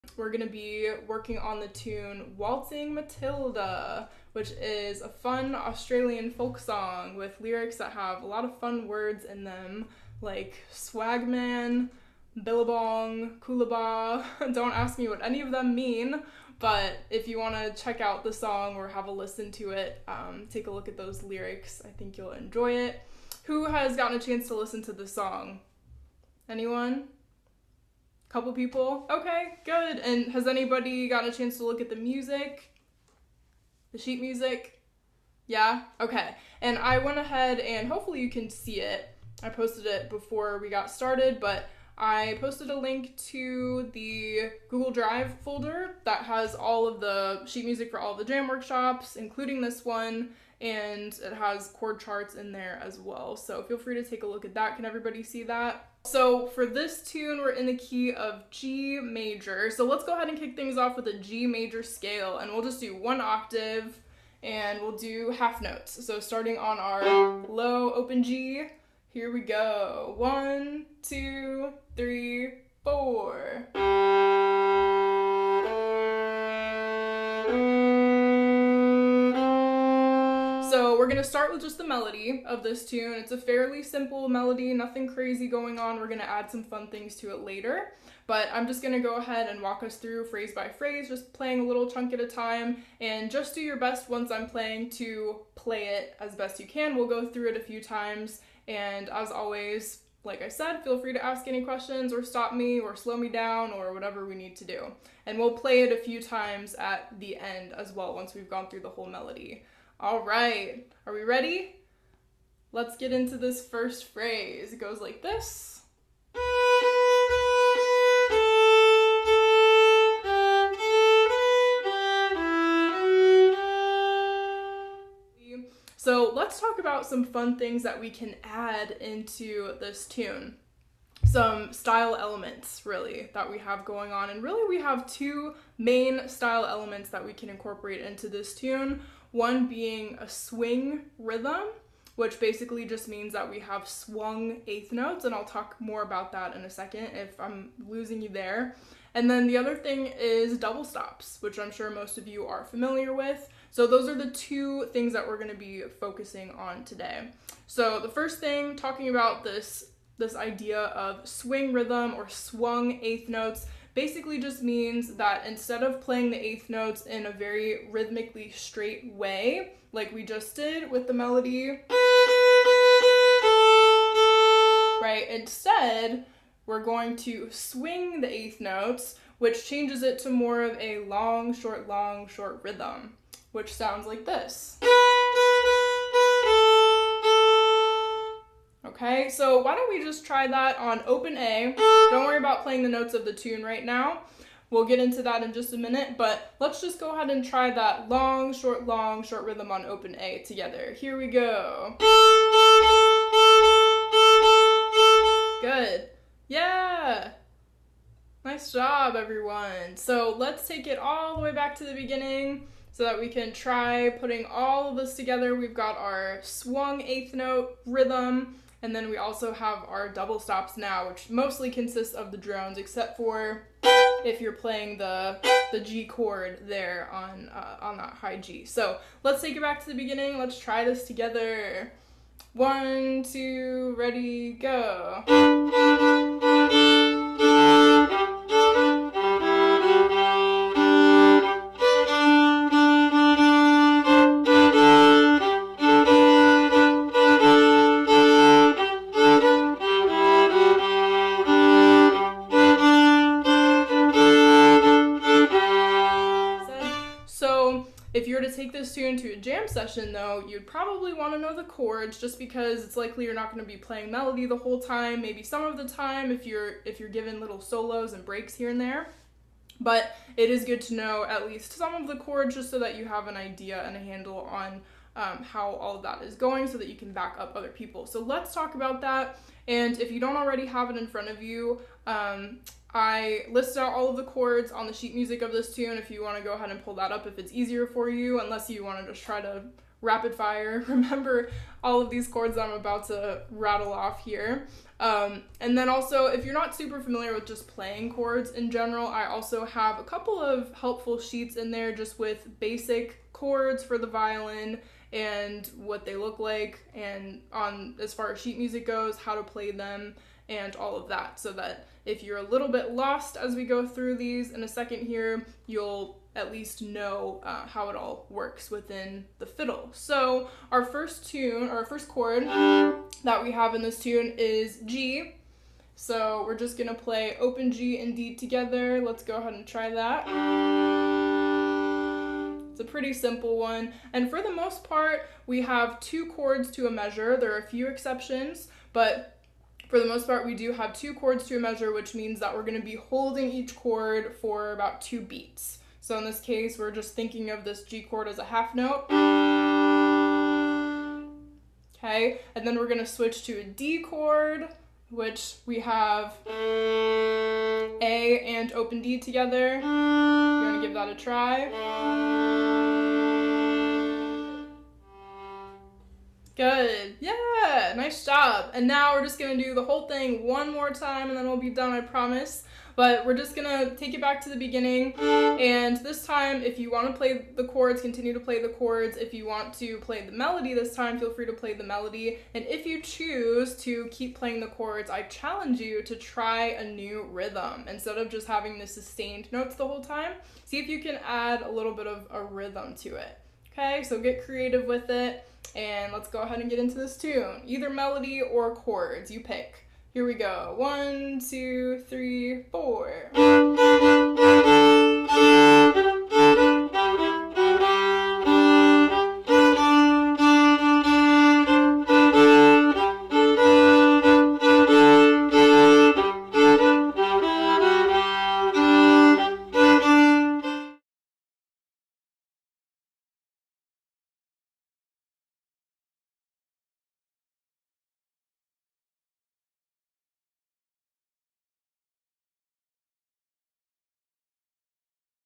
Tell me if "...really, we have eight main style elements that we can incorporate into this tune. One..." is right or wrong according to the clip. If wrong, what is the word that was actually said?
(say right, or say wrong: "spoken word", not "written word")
wrong: "two", not "eight".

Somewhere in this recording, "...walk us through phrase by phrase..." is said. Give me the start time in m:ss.
1:29.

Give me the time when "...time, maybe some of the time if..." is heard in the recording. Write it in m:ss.
4:24.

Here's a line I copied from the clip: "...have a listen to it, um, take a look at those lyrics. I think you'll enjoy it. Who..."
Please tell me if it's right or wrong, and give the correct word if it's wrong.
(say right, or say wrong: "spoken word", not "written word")
right.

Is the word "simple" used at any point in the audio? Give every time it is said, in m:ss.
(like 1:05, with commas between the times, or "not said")
1:23, 5:33.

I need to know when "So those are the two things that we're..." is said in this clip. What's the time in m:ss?
2:33.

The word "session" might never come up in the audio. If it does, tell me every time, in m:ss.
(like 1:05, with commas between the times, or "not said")
4:19.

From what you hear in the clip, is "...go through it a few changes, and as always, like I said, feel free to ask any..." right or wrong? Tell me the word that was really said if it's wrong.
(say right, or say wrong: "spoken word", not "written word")
wrong: "times", not "changes".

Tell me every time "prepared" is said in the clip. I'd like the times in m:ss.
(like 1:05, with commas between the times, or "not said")
not said.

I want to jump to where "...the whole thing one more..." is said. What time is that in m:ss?
6:09.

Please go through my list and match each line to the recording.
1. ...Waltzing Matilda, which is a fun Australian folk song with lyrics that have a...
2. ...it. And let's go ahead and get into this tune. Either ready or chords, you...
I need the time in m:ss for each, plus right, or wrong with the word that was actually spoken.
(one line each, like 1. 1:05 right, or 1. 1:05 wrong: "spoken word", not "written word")
1. 0:02 right
2. 6:35 wrong: "melody", not "ready".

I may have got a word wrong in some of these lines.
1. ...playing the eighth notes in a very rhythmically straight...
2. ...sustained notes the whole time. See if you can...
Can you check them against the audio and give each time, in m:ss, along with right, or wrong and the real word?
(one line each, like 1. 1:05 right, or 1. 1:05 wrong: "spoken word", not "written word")
1. 2:45 right
2. 6:28 right.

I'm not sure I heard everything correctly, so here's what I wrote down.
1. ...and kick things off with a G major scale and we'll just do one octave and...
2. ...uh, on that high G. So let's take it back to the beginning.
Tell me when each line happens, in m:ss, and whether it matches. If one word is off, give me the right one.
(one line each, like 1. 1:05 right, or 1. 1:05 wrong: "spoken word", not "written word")
1. 1:00 right
2. 3:47 right.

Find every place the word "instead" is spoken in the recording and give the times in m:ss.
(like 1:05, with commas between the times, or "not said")
2:45, 2:55, 6:27.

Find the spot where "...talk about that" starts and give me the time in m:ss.
4:38.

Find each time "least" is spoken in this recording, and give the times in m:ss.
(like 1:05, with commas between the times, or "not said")
4:31, 5:16.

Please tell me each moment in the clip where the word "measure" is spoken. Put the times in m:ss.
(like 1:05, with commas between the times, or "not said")
5:36, 5:41.